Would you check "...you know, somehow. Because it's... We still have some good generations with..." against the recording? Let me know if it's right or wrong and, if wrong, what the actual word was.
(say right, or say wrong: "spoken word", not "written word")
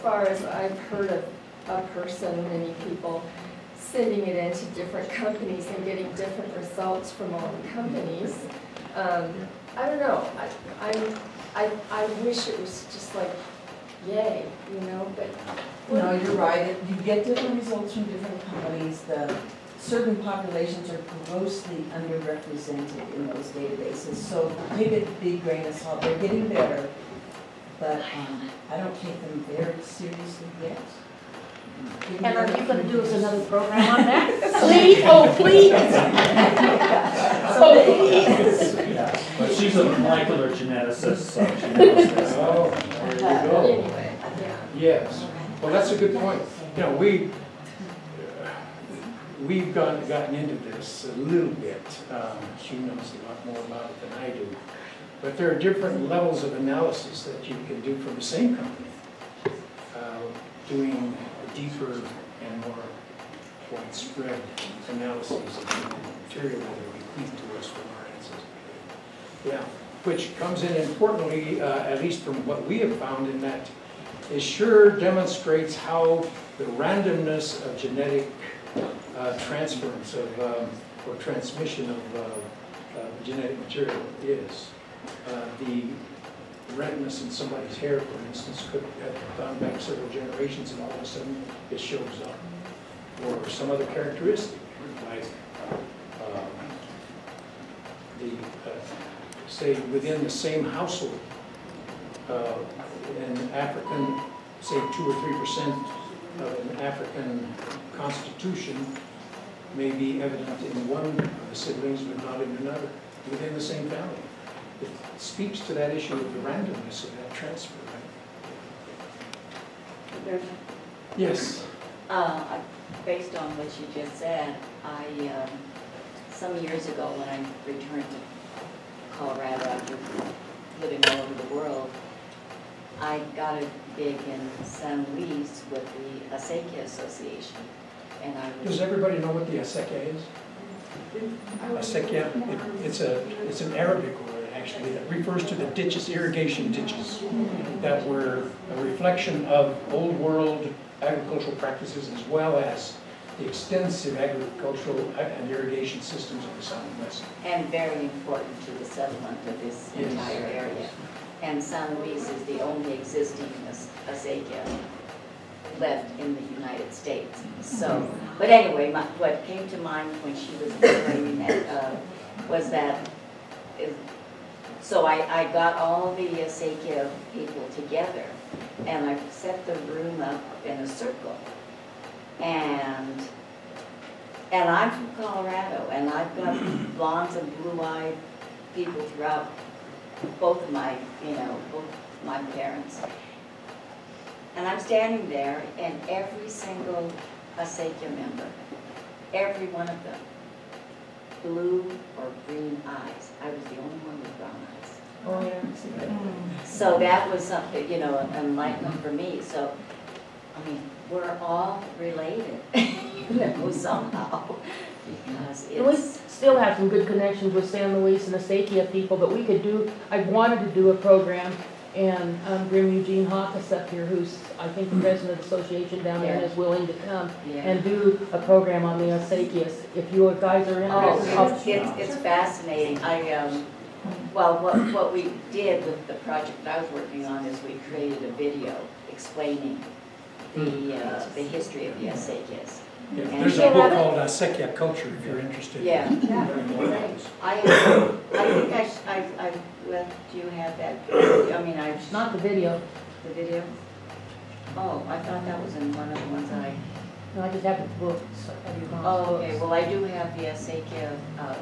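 wrong: "connections", not "generations".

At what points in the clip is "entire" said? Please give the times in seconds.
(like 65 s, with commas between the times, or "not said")
160 s.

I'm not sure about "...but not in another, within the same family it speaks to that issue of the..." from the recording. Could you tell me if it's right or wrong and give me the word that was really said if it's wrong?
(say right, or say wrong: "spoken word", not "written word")
right.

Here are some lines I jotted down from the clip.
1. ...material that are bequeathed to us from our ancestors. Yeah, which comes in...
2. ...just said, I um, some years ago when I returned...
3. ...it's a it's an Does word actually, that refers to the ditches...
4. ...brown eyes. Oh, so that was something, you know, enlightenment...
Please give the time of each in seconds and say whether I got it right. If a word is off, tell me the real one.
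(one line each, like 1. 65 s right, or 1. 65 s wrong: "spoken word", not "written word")
1. 66 s right
2. 123 s right
3. 142 s wrong: "Arabic", not "Does"
4. 204 s right.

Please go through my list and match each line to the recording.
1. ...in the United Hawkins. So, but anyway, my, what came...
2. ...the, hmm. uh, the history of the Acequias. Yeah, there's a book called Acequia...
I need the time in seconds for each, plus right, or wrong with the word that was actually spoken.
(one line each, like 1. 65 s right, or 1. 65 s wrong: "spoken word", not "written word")
1. 166 s wrong: "States", not "Hawkins"
2. 240 s right.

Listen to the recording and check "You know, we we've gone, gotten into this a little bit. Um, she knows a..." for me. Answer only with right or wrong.
right.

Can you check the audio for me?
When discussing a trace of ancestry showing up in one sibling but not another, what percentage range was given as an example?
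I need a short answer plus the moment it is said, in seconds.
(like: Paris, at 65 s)
2 or 3%, at 104 s.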